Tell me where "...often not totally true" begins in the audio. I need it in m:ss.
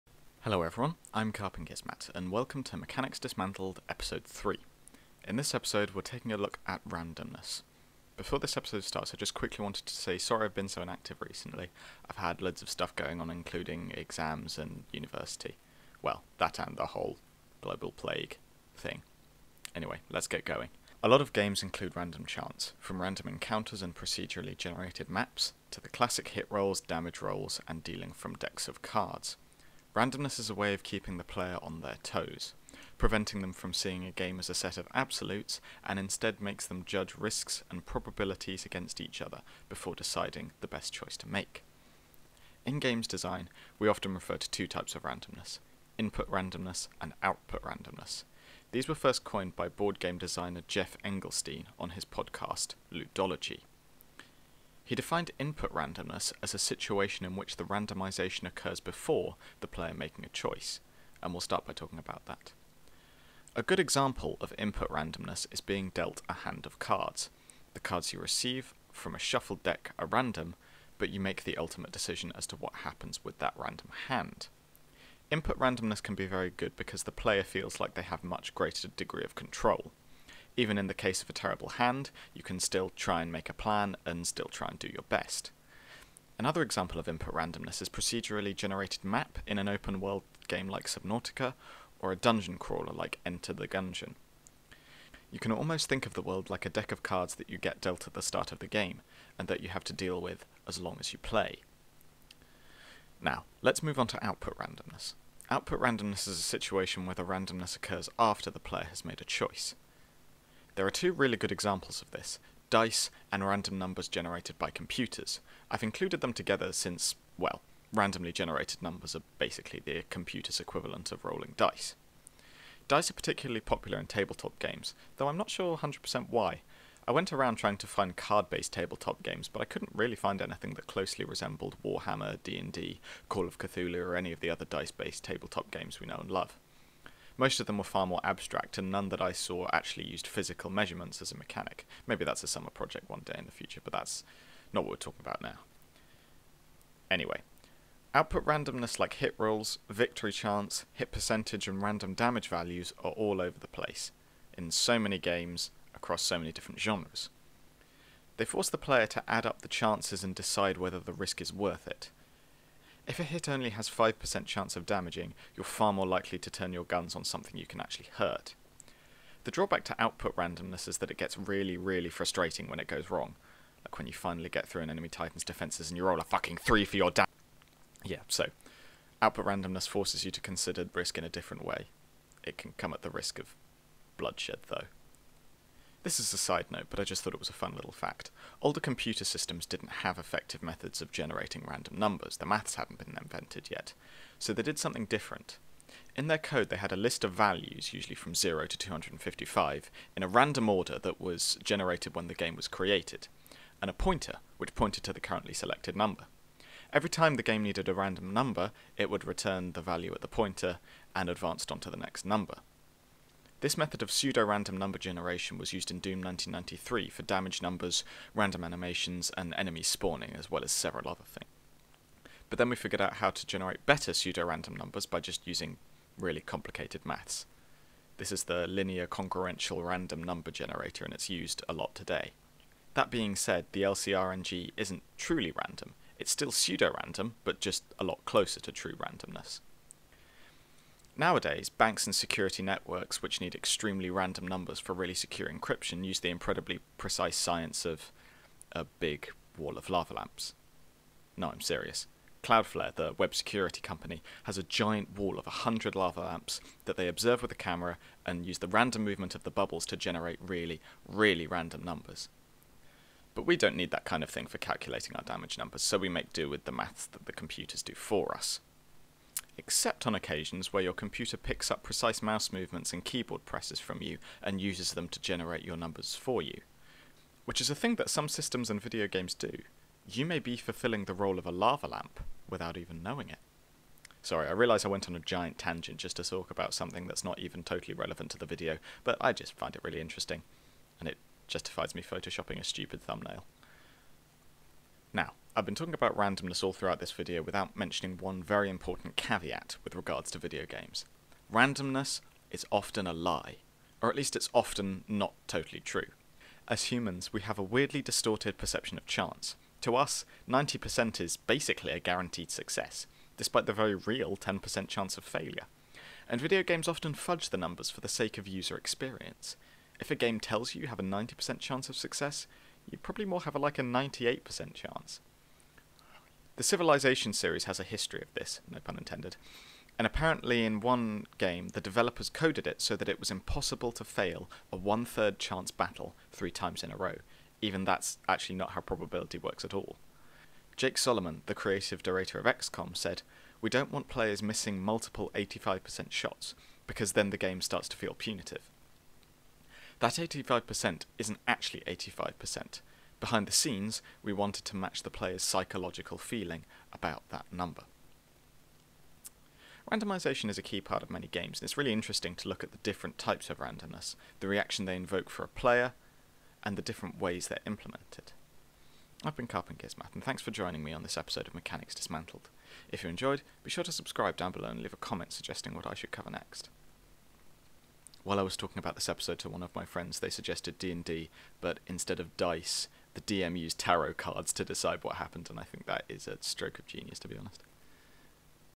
5:04.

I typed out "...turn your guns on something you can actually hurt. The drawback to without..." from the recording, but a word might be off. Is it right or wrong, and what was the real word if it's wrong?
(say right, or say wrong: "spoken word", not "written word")
wrong: "output", not "without".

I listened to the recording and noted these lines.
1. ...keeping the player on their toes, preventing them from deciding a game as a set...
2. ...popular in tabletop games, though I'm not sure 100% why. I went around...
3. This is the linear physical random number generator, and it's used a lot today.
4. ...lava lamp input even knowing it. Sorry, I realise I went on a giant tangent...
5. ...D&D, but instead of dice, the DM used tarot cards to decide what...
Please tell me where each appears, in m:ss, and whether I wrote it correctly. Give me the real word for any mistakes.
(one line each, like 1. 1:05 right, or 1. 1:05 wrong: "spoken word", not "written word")
1. 0:30 wrong: "seeing", not "deciding"
2. 2:03 right
3. 3:48 wrong: "congruential", not "physical"
4. 4:41 wrong: "without", not "input"
5. 6:20 right.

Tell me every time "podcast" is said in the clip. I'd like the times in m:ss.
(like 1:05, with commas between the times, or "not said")
0:52.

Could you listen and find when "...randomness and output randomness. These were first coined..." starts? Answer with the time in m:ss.
0:46.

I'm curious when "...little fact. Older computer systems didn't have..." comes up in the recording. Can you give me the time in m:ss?
3:07.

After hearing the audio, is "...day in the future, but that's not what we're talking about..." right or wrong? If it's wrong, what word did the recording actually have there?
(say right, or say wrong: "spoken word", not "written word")
right.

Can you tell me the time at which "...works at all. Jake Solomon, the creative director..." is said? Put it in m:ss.
5:39.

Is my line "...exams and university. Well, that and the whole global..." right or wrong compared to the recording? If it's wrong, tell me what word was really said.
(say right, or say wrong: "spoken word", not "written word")
right.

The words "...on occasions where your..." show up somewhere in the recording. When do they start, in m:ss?
4:30.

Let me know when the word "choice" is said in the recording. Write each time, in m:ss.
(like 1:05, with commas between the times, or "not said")
0:40, 1:00, 1:49.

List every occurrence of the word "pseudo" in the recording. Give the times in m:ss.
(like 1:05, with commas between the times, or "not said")
3:34, 3:44, 3:56.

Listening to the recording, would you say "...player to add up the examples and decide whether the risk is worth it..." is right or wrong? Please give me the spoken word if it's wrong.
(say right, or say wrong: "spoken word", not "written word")
wrong: "chances", not "examples".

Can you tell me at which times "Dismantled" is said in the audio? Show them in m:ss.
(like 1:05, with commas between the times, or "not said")
0:03, 6:11.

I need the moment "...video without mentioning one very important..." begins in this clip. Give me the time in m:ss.
4:57.